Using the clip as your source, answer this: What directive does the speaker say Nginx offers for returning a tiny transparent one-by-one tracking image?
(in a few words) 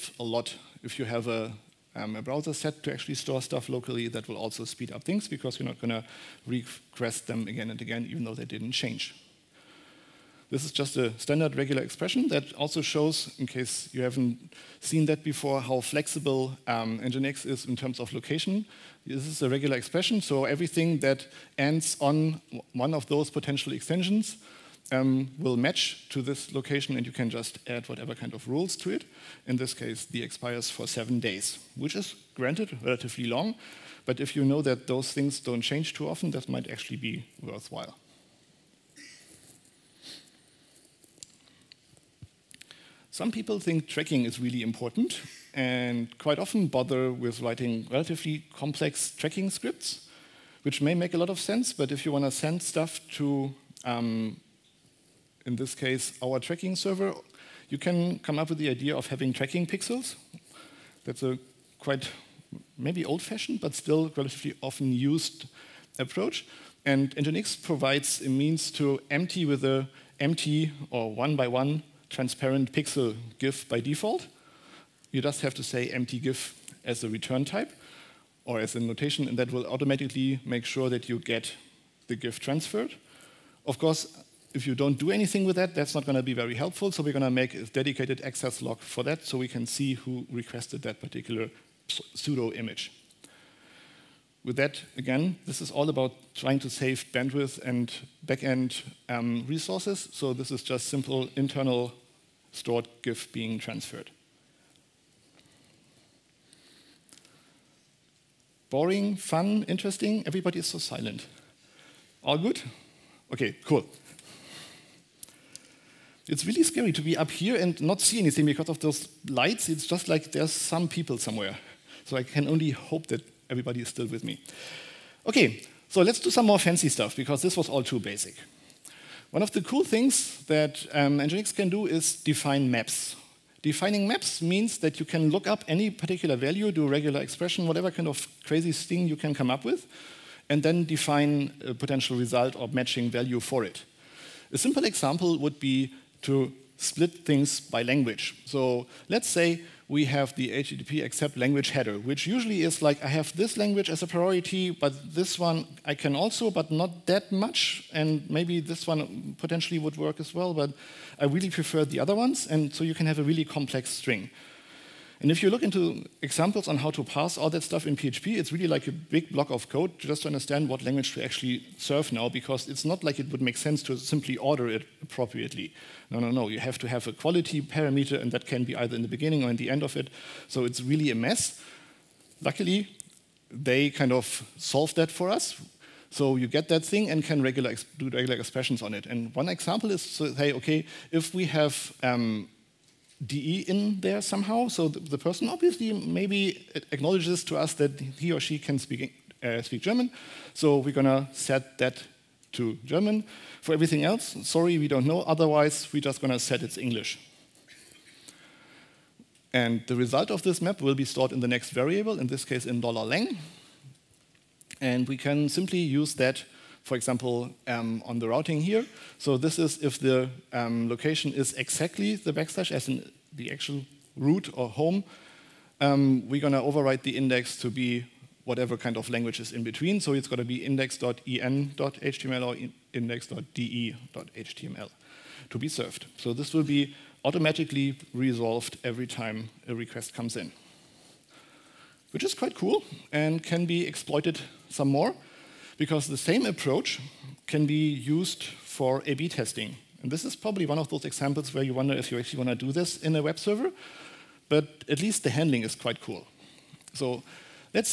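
empty GIF.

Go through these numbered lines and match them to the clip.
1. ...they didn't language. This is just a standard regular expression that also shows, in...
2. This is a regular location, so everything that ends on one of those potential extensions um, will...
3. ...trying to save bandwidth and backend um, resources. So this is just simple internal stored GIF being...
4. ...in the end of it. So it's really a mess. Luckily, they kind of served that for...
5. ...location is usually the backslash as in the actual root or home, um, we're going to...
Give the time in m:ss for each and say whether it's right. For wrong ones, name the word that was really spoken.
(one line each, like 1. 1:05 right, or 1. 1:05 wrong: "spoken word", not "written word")
1. 0:08 wrong: "change", not "language"
2. 0:19 wrong: "expression", not "location"
3. 1:36 right
4. 2:59 wrong: "solved", not "served"
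5. 3:40 wrong: "exactly", not "usually".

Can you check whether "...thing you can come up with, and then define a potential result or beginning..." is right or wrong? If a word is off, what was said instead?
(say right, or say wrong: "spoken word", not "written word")
wrong: "matching", not "beginning".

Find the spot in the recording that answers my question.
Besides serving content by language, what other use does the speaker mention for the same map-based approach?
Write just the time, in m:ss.
4:09.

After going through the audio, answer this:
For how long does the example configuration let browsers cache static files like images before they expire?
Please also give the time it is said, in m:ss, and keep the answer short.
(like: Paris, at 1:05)
7 days, at 0:30.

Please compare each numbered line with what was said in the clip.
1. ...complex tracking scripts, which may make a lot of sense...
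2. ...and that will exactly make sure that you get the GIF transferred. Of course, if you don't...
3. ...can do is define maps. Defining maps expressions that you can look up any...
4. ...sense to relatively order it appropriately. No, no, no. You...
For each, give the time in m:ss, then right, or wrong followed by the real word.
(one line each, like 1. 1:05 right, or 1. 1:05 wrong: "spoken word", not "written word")
1. 0:48 right
2. 1:19 wrong: "automatically", not "exactly"
3. 2:11 wrong: "means", not "expressions"
4. 2:53 wrong: "simply", not "relatively".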